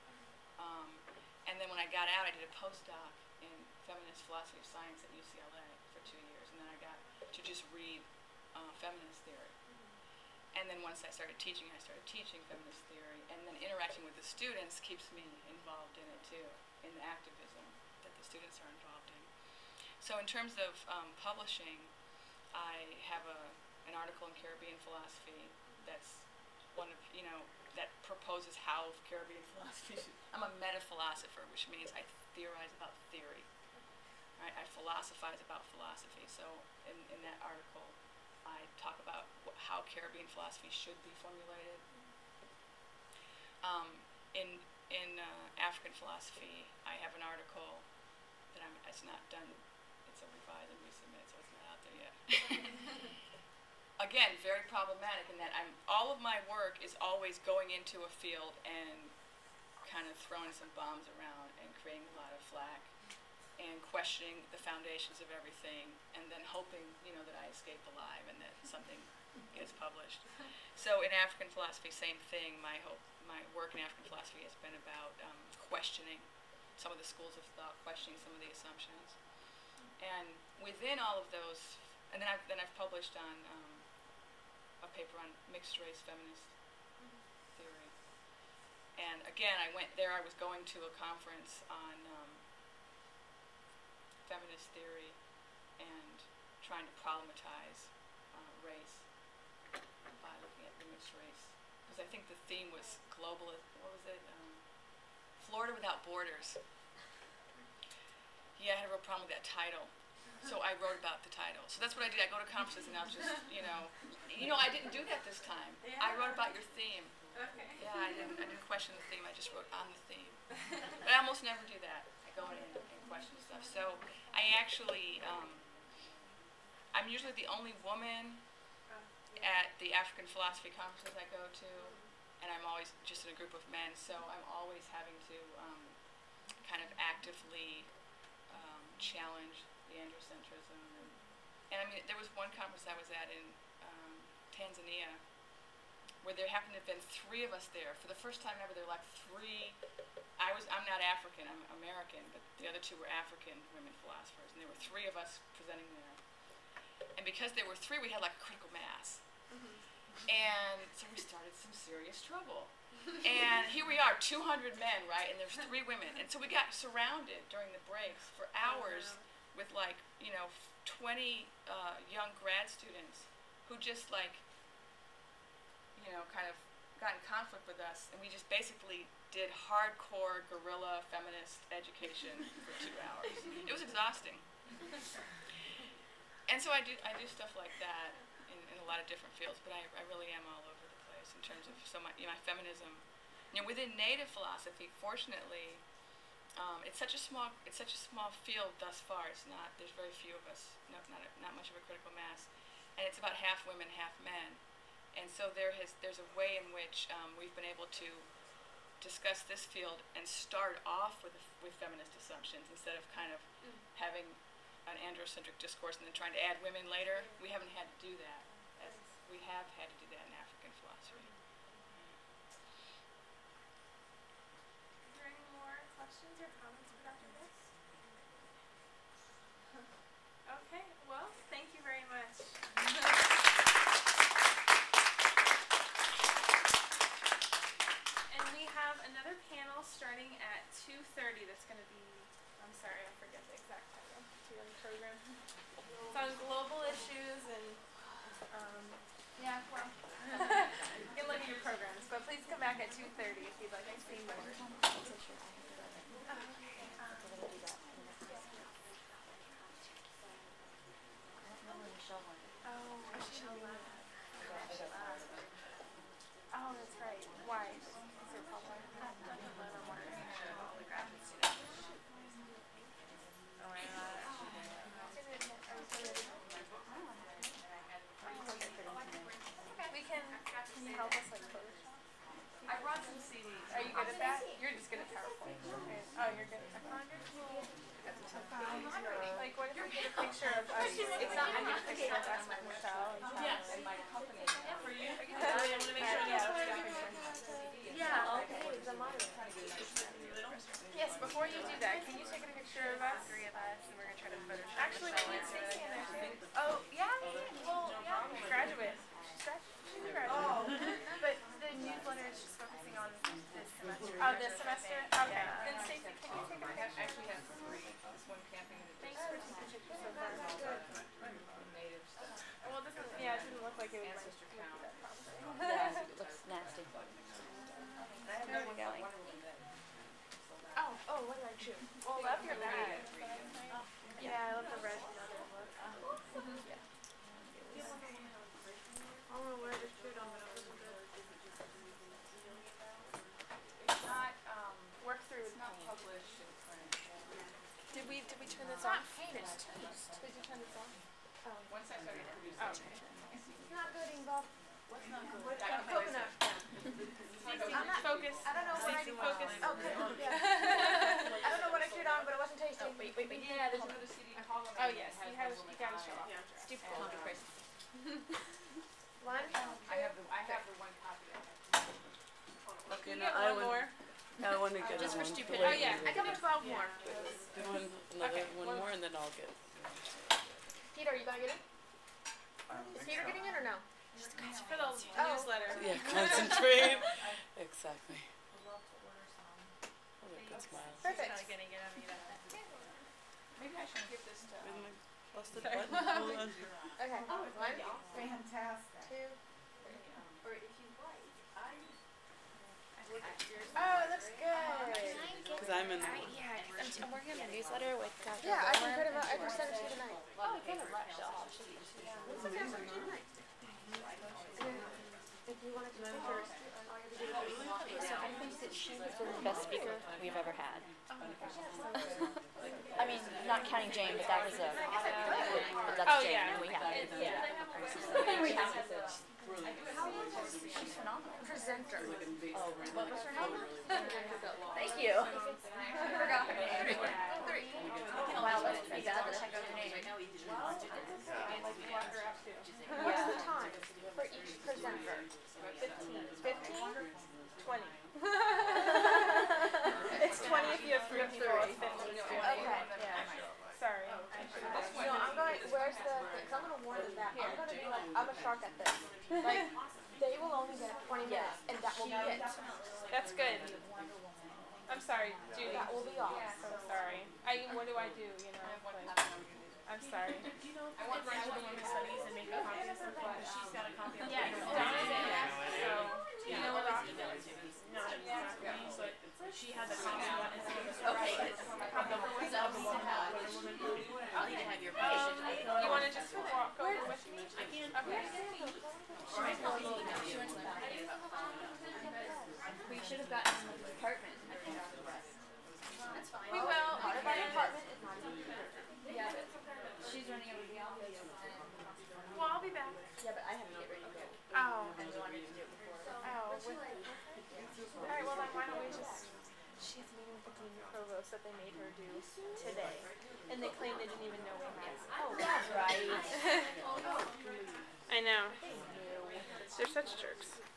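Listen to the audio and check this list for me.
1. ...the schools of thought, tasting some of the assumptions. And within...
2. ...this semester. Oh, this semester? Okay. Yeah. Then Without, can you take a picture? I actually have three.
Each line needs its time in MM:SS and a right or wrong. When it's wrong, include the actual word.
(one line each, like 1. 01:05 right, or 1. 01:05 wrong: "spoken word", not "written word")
1. 01:16 wrong: "questioning", not "tasting"
2. 05:13 wrong: "Stacy", not "Without".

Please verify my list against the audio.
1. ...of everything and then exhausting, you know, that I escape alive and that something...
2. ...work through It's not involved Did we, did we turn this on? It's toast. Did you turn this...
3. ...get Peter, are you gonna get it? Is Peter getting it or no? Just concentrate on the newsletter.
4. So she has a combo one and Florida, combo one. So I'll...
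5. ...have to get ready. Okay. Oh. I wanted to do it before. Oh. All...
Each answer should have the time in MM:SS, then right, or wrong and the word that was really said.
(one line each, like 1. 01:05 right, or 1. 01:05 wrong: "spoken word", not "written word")
1. 01:05 wrong: "hoping", not "exhausting"
2. 05:45 wrong: "published", not "involved"
3. 06:19 right
4. 07:58 wrong: "Okay", not "Florida"
5. 08:23 right.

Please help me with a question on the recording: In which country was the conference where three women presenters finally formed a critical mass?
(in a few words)
Tanzania.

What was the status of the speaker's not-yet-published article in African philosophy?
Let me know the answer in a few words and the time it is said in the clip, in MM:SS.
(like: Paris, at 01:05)
revise and resubmit, at 00:50.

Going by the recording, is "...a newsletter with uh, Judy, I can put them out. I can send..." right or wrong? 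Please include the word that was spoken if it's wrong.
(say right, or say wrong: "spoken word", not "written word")
wrong: "Yeah", not "Judy".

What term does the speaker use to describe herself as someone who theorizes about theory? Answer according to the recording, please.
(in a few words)
meta philosopher.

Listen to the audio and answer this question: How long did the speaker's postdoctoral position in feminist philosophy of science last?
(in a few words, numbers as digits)
2 years.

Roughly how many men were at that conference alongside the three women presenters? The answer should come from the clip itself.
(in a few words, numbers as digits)
200.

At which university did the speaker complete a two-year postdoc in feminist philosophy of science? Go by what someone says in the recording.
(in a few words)
UCLA.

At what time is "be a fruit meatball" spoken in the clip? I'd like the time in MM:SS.
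07:30.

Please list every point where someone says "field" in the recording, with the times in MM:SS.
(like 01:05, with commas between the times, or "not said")
00:58, 03:09, 03:18, 03:29.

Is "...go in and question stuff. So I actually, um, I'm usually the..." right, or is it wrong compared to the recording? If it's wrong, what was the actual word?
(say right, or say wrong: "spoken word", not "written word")
right.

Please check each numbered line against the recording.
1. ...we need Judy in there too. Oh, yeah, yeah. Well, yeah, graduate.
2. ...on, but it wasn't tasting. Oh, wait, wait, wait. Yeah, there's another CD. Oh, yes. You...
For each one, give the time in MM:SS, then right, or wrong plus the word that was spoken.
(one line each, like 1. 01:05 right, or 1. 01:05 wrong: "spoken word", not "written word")
1. 05:05 wrong: "Stacey", not "Judy"
2. 06:02 right.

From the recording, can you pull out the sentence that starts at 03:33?
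having an androcentric discourse and then trying to add women later.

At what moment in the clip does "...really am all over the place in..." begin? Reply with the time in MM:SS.
03:10.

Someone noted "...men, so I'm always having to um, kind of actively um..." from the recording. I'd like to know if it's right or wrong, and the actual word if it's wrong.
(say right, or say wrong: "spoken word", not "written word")
right.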